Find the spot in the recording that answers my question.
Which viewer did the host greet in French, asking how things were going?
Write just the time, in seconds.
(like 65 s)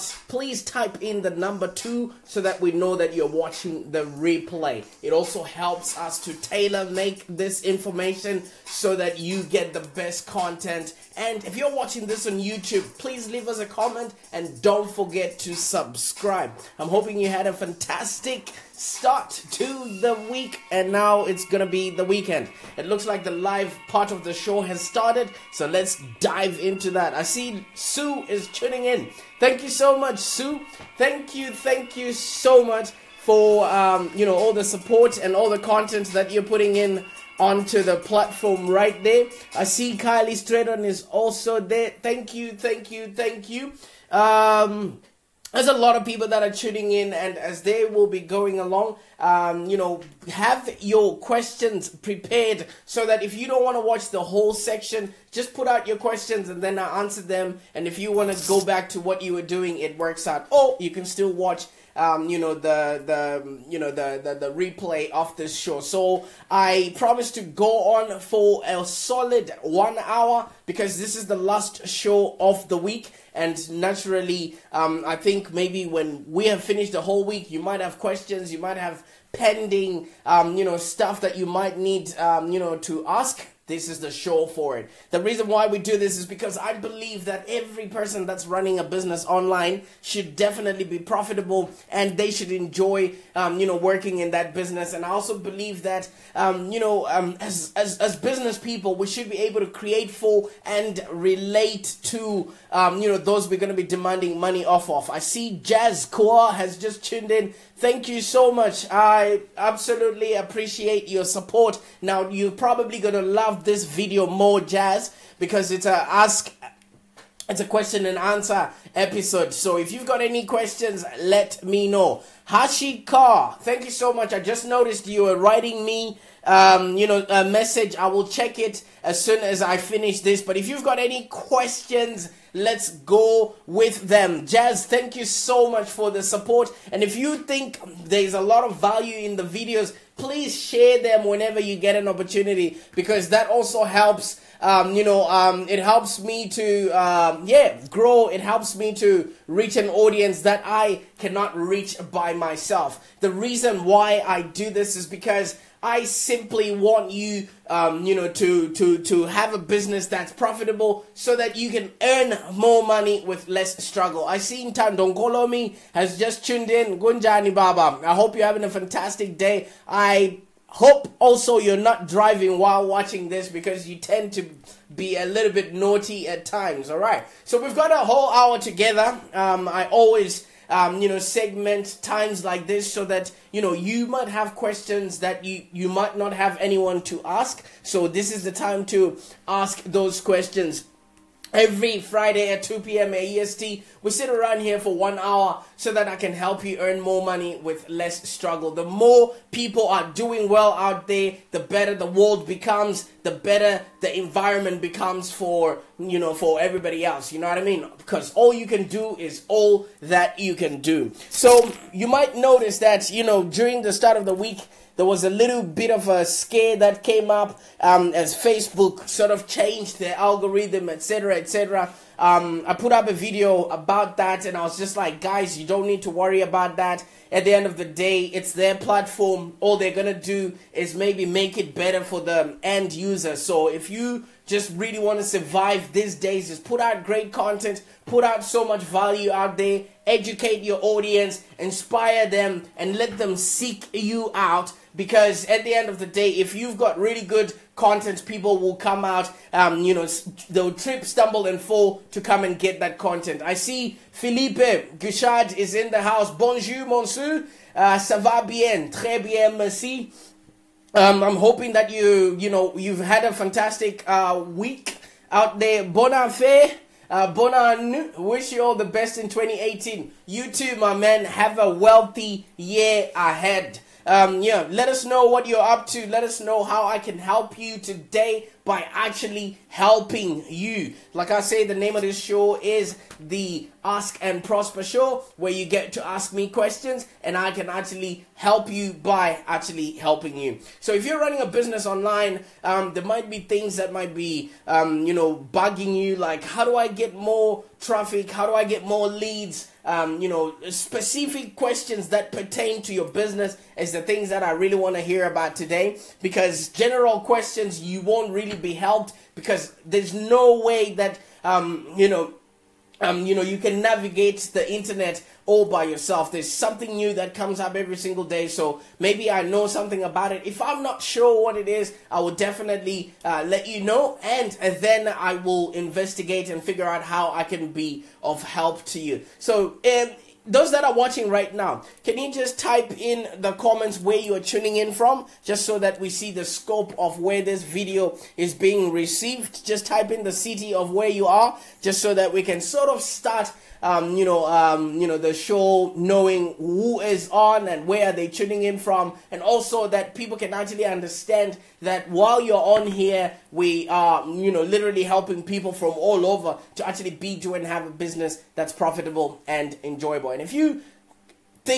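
254 s.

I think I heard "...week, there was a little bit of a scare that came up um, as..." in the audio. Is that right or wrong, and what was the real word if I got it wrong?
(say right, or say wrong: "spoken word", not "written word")
right.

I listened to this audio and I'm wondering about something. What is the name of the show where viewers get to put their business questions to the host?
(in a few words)
Ask and Prosper Show.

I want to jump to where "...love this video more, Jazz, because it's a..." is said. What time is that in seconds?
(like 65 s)
113 s.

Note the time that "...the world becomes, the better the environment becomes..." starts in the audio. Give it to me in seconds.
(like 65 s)
201 s.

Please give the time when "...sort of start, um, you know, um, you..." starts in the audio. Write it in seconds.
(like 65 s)
342 s.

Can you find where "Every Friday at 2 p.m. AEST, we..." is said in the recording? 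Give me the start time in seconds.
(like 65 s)
191 s.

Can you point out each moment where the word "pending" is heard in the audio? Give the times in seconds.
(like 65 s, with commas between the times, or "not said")
79 s.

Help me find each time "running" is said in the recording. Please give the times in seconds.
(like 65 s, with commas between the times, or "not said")
88 s, 291 s.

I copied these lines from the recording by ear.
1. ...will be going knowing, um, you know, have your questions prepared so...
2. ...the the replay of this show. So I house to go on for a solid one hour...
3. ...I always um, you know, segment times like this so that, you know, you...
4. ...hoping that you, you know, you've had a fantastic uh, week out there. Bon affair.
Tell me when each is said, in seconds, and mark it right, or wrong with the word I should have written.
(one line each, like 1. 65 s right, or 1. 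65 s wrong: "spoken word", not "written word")
1. 47 s wrong: "along", not "knowing"
2. 64 s wrong: "promise", not "house"
3. 179 s right
4. 261 s right.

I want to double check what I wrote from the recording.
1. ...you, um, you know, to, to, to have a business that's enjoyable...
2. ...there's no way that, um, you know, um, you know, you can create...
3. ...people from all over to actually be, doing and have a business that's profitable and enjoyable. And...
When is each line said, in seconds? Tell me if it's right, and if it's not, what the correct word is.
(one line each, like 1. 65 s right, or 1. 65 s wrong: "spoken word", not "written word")
1. 157 s wrong: "profitable", not "enjoyable"
2. 309 s wrong: "navigate", not "create"
3. 355 s right.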